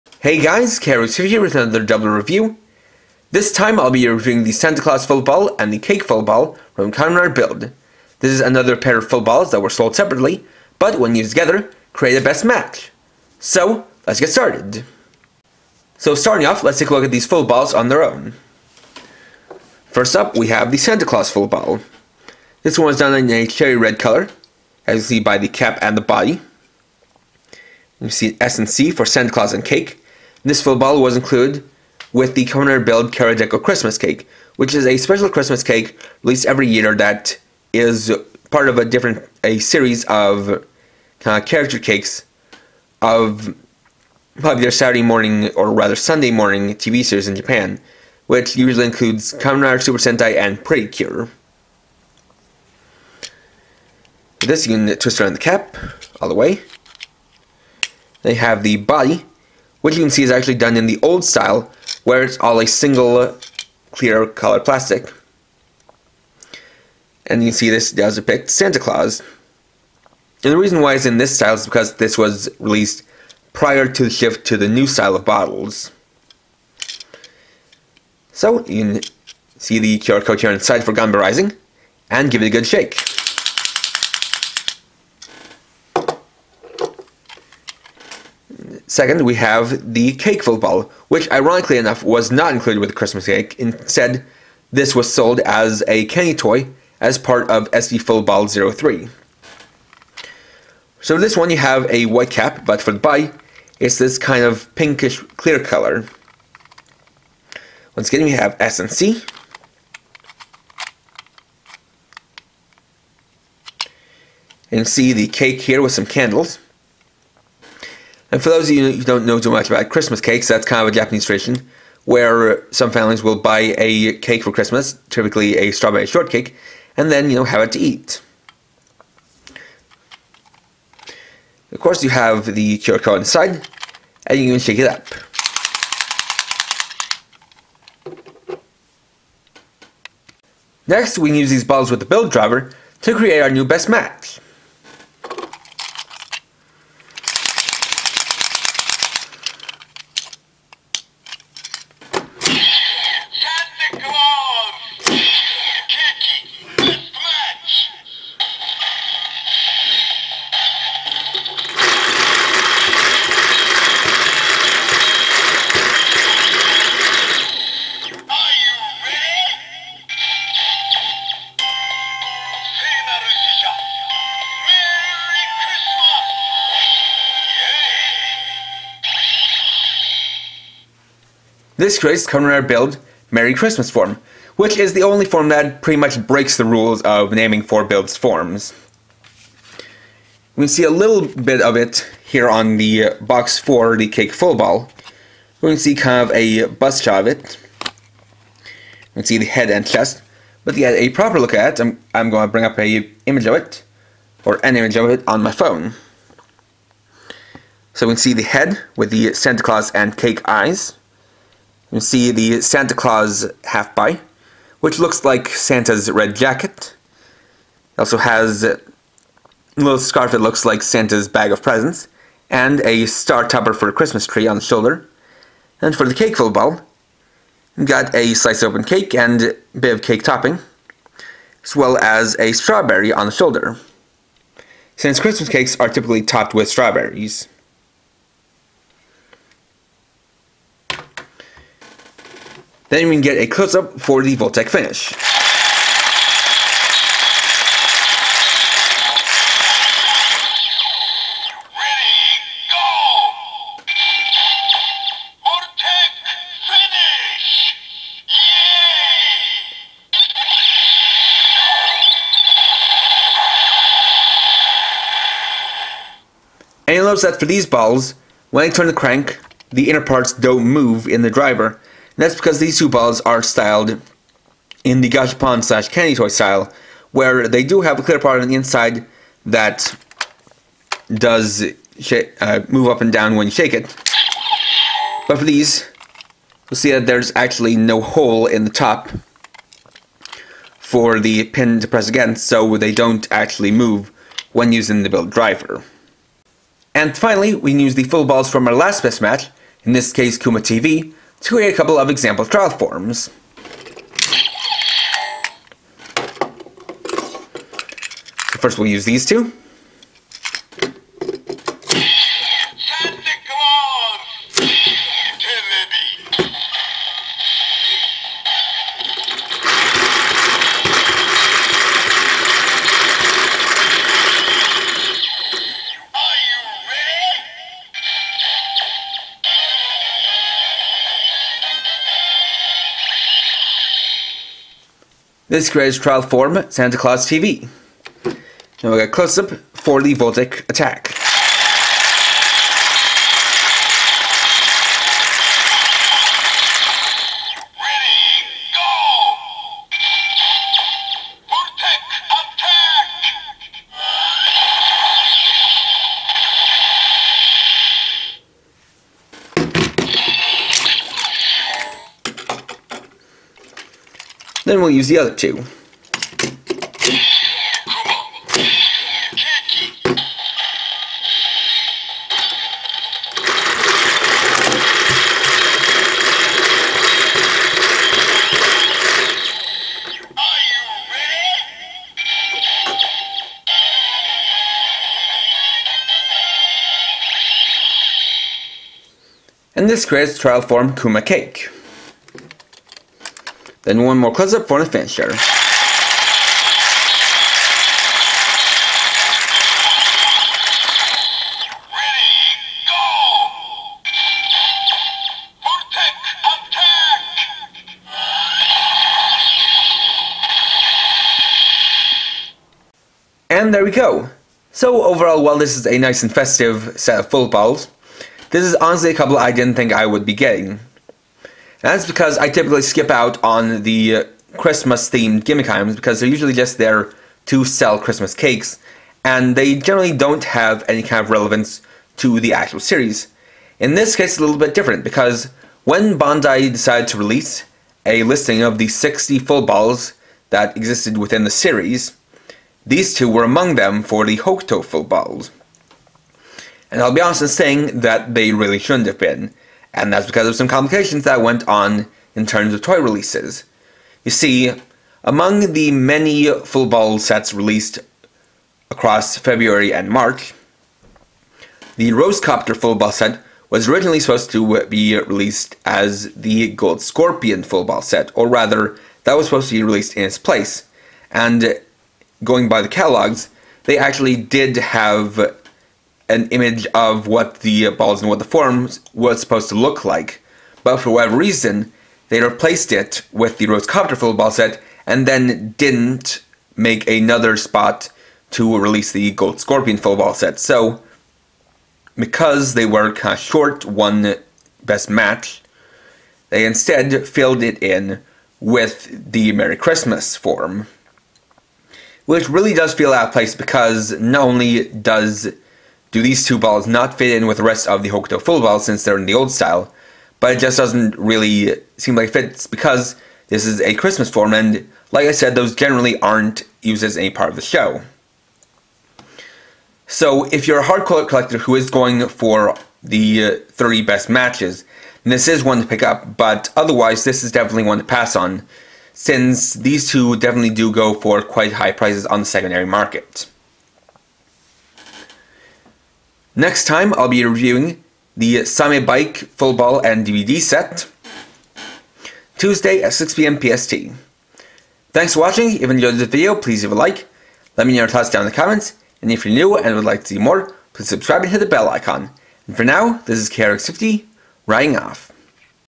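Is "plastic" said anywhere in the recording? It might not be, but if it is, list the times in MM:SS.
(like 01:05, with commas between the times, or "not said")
01:04.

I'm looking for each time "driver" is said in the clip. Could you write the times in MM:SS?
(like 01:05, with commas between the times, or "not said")
02:22, 04:31, 04:55.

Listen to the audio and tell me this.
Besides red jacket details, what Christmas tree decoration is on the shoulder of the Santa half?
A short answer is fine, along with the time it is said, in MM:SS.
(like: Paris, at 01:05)
Star topper, at 03:43.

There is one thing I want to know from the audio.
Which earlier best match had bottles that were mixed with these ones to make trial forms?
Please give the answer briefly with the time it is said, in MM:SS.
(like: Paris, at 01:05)
Kuma TV, at 05:00.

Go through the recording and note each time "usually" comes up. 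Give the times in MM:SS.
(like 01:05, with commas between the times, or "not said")
00:48, 07:06.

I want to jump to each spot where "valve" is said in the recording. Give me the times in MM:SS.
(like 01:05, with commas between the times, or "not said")
not said.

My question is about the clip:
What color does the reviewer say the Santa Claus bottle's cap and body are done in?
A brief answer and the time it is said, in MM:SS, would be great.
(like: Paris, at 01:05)
Cherry red, at 00:23.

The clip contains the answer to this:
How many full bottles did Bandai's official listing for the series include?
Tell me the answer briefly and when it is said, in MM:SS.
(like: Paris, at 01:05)
60, at 07:18.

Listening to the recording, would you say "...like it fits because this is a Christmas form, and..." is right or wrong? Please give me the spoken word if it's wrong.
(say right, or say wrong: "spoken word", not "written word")
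right.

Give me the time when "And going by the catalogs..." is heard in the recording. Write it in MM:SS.
07:51.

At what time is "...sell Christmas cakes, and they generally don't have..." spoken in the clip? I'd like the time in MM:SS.
07:07.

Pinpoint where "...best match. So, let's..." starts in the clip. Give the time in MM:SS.
00:12.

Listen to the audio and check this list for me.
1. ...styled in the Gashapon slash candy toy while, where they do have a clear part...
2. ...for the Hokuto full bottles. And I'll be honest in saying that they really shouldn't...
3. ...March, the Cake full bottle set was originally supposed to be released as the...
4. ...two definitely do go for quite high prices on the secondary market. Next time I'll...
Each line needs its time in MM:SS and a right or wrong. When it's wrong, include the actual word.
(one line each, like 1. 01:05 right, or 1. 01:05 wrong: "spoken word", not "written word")
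1. 04:33 wrong: "style", not "while"
2. 07:24 right
3. 07:40 wrong: "Rosecopter", not "Cake"
4. 08:50 right.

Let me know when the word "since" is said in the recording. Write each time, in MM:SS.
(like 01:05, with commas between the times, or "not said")
03:54, 08:28, 08:49.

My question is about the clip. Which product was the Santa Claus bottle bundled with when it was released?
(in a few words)
Rider Build Karadeko Christmas Cake.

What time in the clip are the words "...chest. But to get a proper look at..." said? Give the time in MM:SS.
03:19.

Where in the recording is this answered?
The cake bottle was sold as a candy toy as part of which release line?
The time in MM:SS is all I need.
01:37.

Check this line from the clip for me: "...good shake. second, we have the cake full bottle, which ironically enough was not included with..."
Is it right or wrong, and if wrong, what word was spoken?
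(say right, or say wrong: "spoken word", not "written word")
right.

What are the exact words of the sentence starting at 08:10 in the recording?
So, because they were kind of short one best match, they instead filled it in with the Merry Christmas form.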